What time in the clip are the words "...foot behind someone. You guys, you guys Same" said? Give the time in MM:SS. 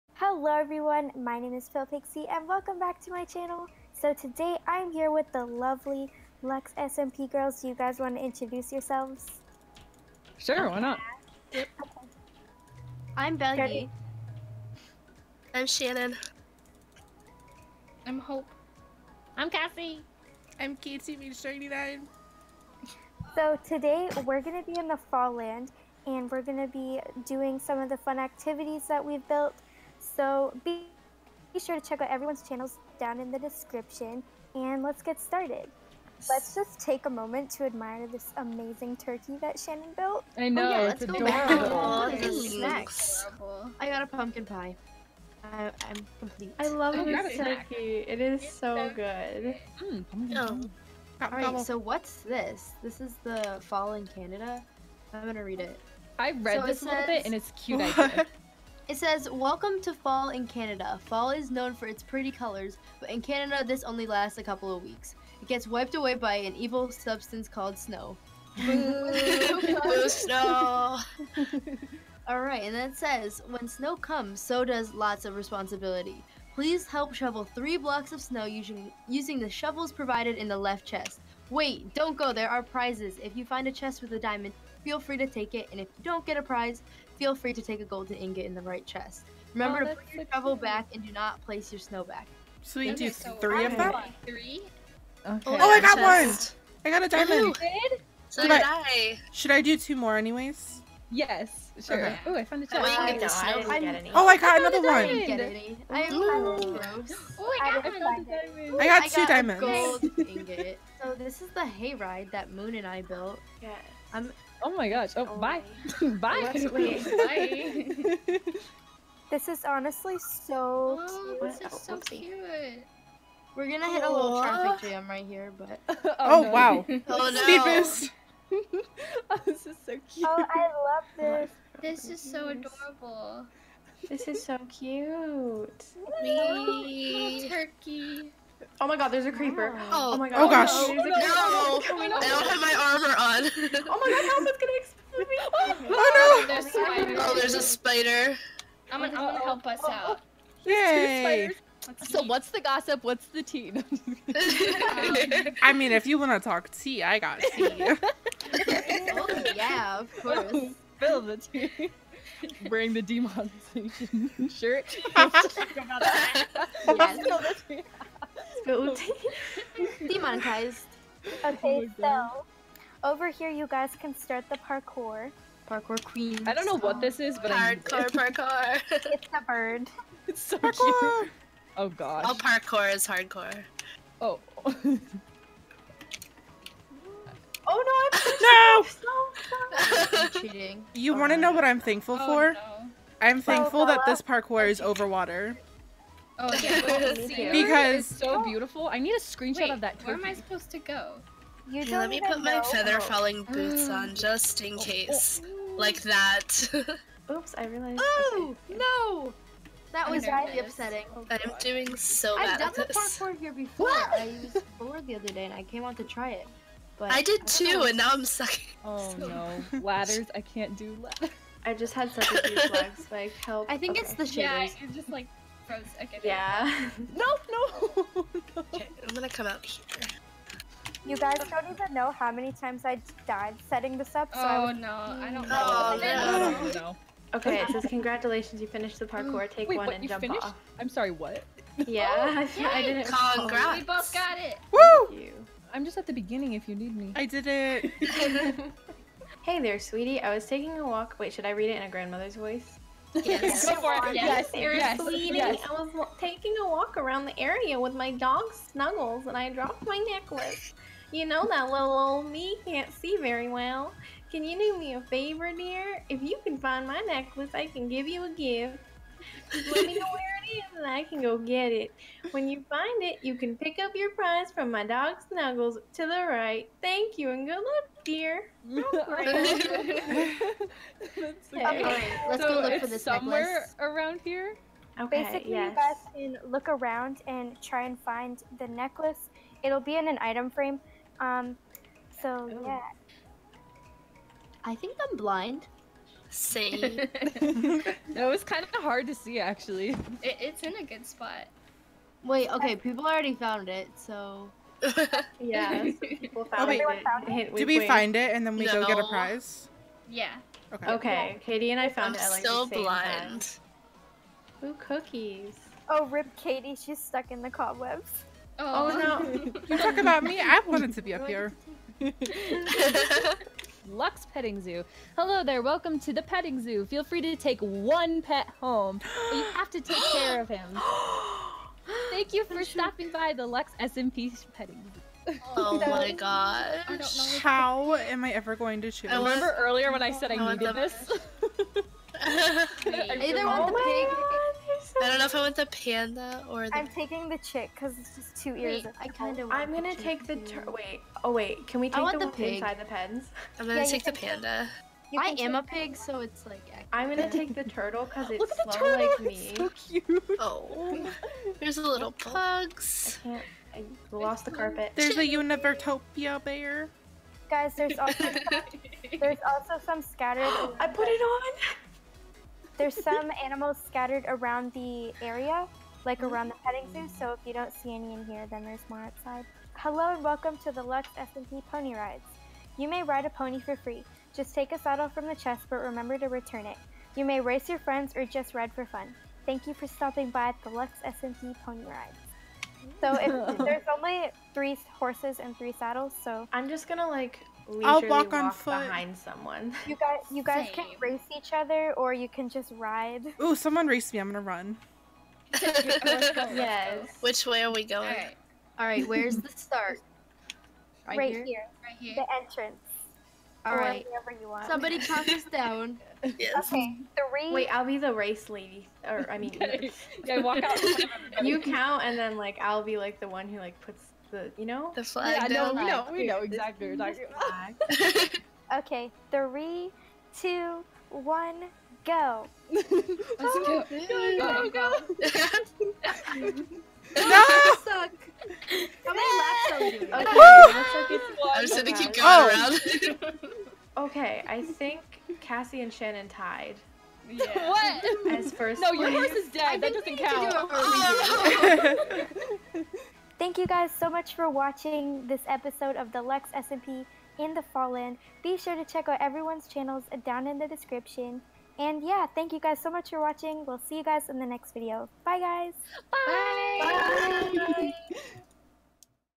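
06:38.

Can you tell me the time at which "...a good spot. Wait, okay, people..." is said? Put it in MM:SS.
05:00.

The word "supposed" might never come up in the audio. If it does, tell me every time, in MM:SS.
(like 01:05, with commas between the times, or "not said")
03:20.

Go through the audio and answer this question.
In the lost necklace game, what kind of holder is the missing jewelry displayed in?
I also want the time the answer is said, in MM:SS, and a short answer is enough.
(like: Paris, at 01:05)
Item frame, at 04:50.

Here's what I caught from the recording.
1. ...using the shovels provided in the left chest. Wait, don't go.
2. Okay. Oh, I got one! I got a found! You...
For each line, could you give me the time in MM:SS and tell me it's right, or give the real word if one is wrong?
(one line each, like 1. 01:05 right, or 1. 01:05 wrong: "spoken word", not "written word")
1. 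01:19 right
2. 01:35 wrong: "diamond", not "found".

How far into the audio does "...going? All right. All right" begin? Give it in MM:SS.
06:47.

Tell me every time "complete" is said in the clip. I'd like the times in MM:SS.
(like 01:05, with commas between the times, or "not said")
00:46.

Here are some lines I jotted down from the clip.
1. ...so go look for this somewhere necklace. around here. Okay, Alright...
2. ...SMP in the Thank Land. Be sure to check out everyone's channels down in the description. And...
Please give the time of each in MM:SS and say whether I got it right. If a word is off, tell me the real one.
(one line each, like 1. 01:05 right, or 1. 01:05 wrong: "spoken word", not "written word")
1. 04:42 wrong: "Basically", not "Alright"
2. 07:36 wrong: "Fall", not "Thank".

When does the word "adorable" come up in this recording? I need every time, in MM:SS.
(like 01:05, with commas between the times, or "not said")
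00:41, 02:12.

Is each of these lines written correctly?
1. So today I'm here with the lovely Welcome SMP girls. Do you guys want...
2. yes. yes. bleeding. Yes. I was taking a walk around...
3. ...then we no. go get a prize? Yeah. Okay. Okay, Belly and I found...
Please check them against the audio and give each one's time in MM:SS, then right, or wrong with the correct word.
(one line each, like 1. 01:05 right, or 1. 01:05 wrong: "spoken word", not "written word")
1. 00:03 wrong: "Lux", not "Welcome"
2. 04:14 right
3. 05:08 wrong: "Katie", not "Belly".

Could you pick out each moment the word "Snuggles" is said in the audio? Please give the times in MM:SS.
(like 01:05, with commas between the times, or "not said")
04:18, 04:35.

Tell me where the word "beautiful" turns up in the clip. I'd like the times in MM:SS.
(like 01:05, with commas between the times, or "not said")
03:18.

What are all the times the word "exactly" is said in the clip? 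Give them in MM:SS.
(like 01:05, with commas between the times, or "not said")
07:06.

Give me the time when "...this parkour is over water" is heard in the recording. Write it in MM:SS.
03:14.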